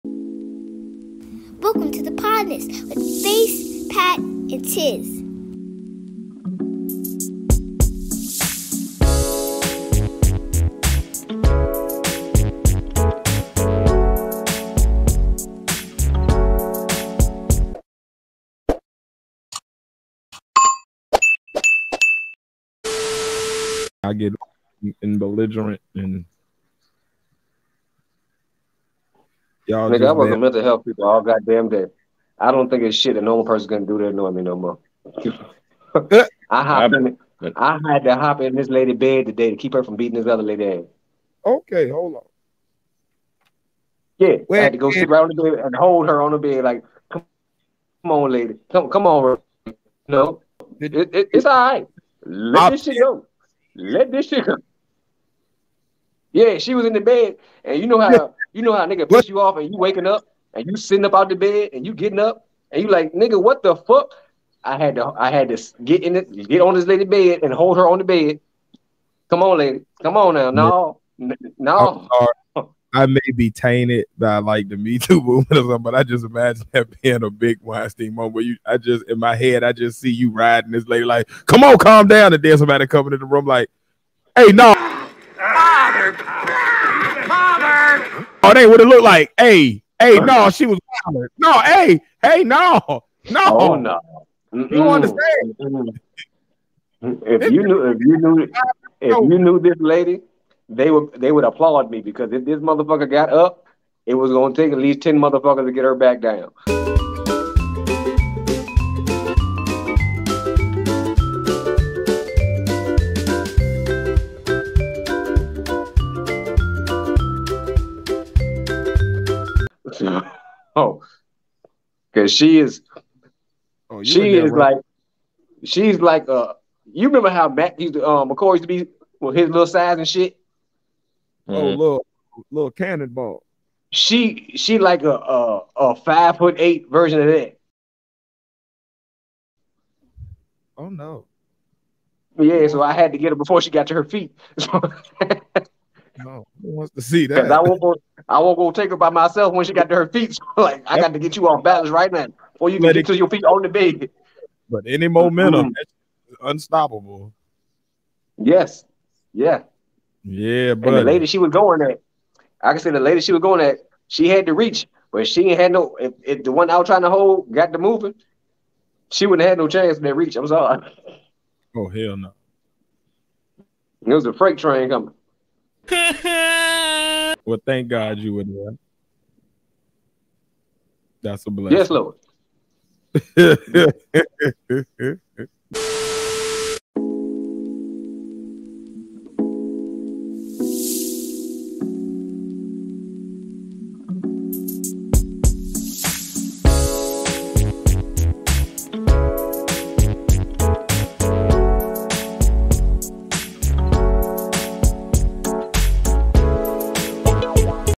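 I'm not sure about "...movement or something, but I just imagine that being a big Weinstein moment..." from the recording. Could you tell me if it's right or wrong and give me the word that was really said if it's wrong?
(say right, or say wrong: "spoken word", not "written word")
right.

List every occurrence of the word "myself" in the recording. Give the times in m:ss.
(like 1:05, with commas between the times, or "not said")
2:29.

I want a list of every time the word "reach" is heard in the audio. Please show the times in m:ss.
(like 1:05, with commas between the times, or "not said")
2:44, 2:50.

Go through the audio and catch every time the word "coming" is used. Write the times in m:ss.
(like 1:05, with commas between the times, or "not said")
1:22, 2:54.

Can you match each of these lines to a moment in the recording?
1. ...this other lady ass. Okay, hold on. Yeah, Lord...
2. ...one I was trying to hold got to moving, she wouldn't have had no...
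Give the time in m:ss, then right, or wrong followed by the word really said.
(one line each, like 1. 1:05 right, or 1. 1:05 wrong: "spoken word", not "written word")
1. 0:40 wrong: "Where", not "Lord"
2. 2:46 right.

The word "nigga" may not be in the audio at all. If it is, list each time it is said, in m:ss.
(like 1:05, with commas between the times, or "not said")
0:29, 0:58, 1:03.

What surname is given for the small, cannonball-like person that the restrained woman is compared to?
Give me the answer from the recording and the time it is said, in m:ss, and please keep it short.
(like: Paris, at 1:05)
McCoy, at 2:08.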